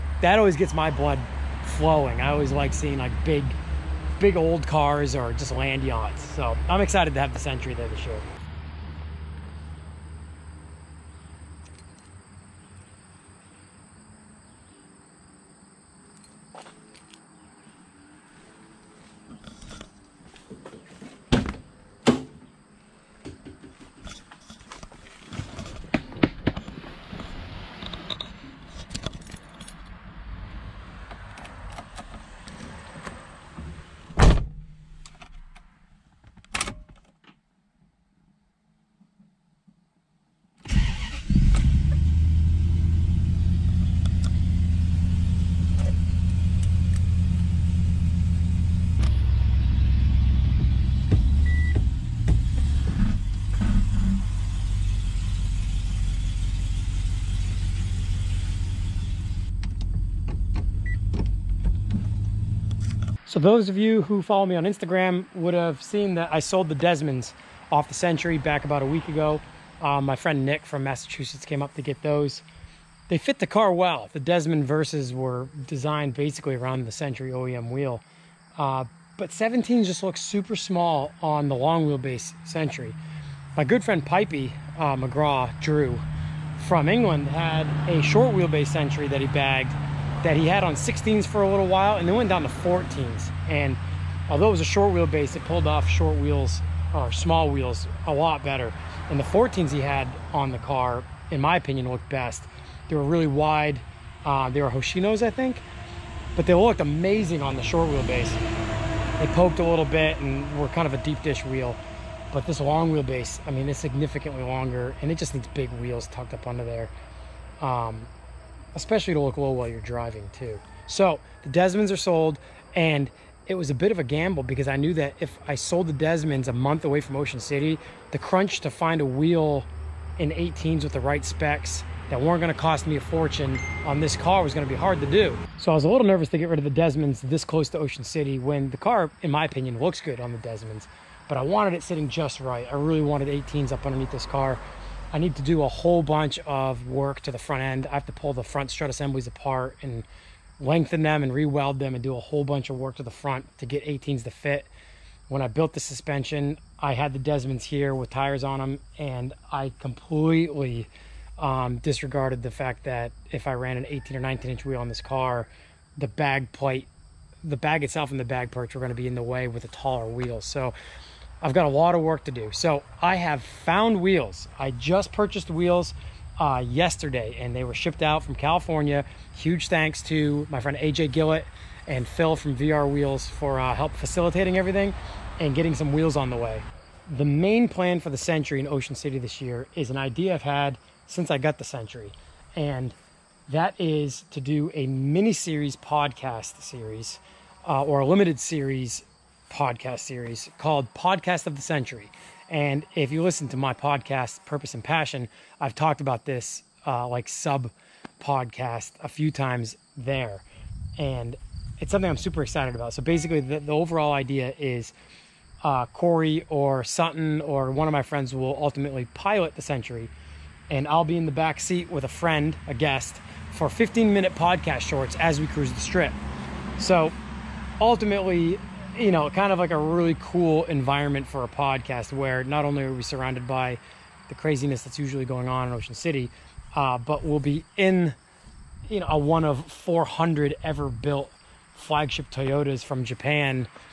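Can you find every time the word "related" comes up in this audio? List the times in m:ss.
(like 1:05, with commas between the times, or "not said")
not said.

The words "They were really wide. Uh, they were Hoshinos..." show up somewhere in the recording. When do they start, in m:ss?
1:42.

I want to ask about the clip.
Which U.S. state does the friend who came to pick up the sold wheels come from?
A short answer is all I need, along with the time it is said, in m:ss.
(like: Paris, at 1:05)
Massachusetts, at 1:10.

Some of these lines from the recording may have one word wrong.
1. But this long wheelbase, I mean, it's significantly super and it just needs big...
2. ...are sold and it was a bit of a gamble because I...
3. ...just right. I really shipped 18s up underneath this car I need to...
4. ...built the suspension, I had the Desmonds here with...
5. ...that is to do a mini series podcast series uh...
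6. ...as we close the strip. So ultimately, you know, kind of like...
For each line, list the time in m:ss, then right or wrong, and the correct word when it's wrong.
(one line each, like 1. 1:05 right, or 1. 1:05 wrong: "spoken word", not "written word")
1. 1:52 wrong: "longer", not "super"
2. 2:01 right
3. 2:22 wrong: "wanted", not "shipped"
4. 2:35 right
5. 3:13 right
6. 3:45 wrong: "cruise", not "close".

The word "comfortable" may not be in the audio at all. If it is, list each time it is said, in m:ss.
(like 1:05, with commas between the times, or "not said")
not said.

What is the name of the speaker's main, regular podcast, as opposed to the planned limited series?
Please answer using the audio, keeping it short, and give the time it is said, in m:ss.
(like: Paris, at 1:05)
Purpose and Passion, at 3:24.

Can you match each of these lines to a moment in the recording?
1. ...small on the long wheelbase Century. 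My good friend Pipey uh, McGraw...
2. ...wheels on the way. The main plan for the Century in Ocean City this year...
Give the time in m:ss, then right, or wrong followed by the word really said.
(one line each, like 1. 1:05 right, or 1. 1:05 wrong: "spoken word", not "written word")
1. 1:20 right
2. 3:05 right.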